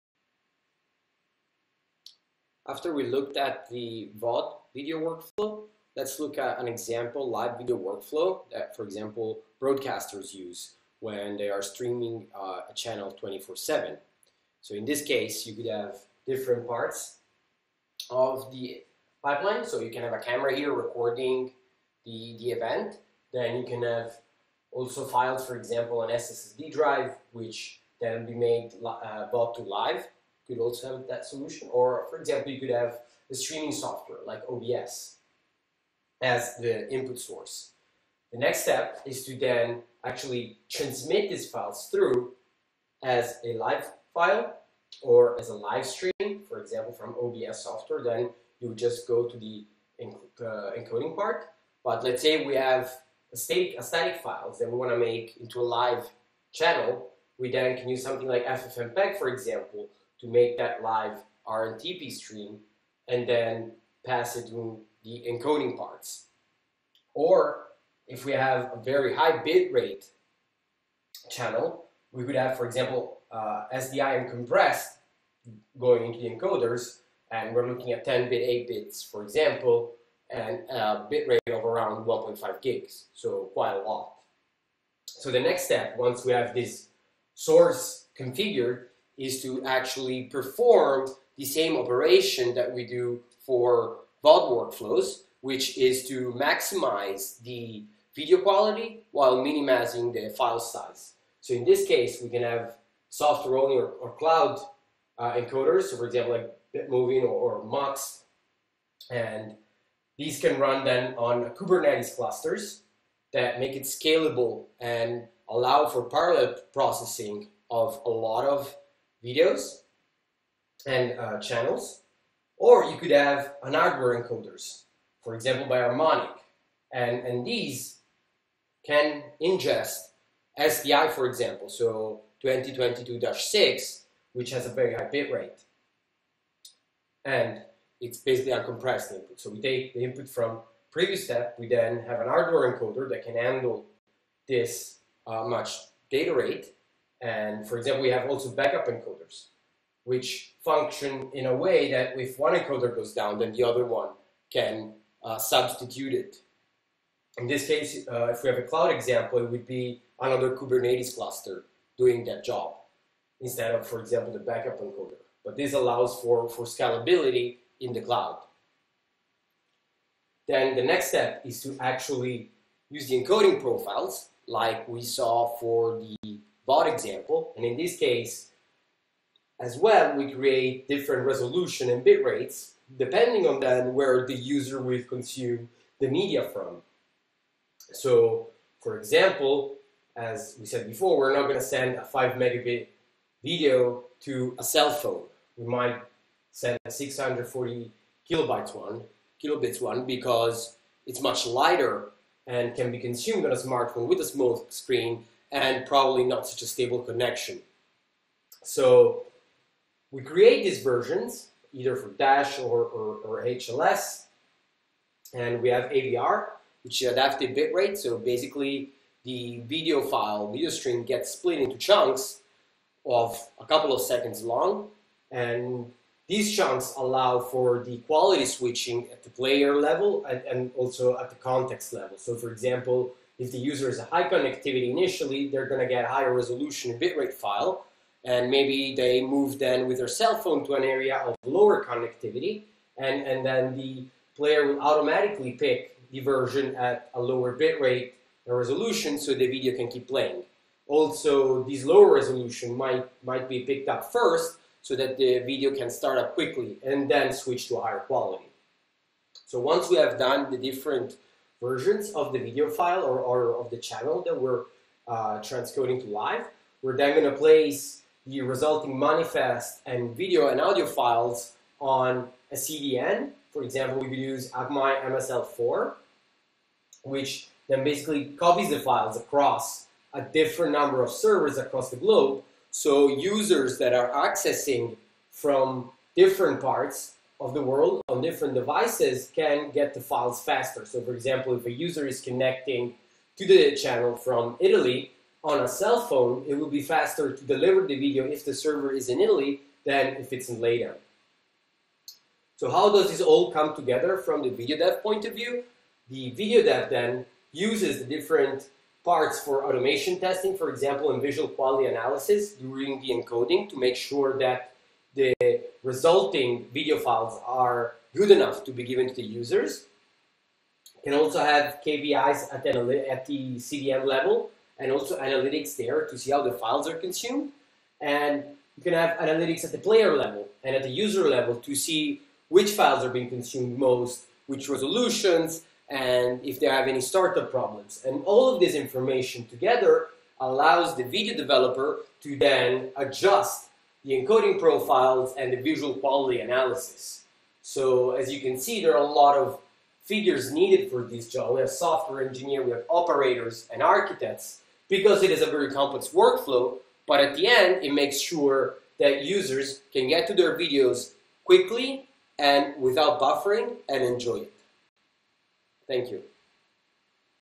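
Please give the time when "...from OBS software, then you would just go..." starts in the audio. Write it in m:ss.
0:46.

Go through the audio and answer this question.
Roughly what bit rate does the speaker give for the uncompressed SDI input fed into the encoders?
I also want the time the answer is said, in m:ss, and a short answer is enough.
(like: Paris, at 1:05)
1.5 gigs, at 1:22.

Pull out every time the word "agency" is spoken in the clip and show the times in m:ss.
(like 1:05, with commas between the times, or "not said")
not said.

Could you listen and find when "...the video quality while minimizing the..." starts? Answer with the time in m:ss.
1:37.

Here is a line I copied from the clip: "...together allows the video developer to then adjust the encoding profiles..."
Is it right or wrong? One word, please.
right.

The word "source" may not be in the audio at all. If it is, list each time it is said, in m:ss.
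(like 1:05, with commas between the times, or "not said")
0:37, 1:27.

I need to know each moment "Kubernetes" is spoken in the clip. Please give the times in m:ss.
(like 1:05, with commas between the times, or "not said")
1:51, 2:40.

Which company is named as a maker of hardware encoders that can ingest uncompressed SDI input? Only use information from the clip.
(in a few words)
Harmonic.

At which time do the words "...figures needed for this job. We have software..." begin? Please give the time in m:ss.
5:50.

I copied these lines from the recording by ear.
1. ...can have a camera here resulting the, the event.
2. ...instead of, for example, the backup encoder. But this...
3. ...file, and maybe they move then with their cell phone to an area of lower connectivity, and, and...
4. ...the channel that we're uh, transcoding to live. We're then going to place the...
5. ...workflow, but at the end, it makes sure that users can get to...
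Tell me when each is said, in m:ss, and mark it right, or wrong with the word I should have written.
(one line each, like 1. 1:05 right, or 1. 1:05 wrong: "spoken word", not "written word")
1. 0:19 wrong: "recording", not "resulting"
2. 2:43 right
3. 3:57 right
4. 4:23 right
5. 5:56 right.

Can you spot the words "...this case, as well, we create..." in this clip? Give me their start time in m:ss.
2:57.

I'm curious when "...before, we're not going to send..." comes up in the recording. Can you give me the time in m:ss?
3:10.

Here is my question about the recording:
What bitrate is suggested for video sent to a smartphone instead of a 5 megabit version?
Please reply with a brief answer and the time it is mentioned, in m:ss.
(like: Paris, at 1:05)
640 kilobits, at 3:16.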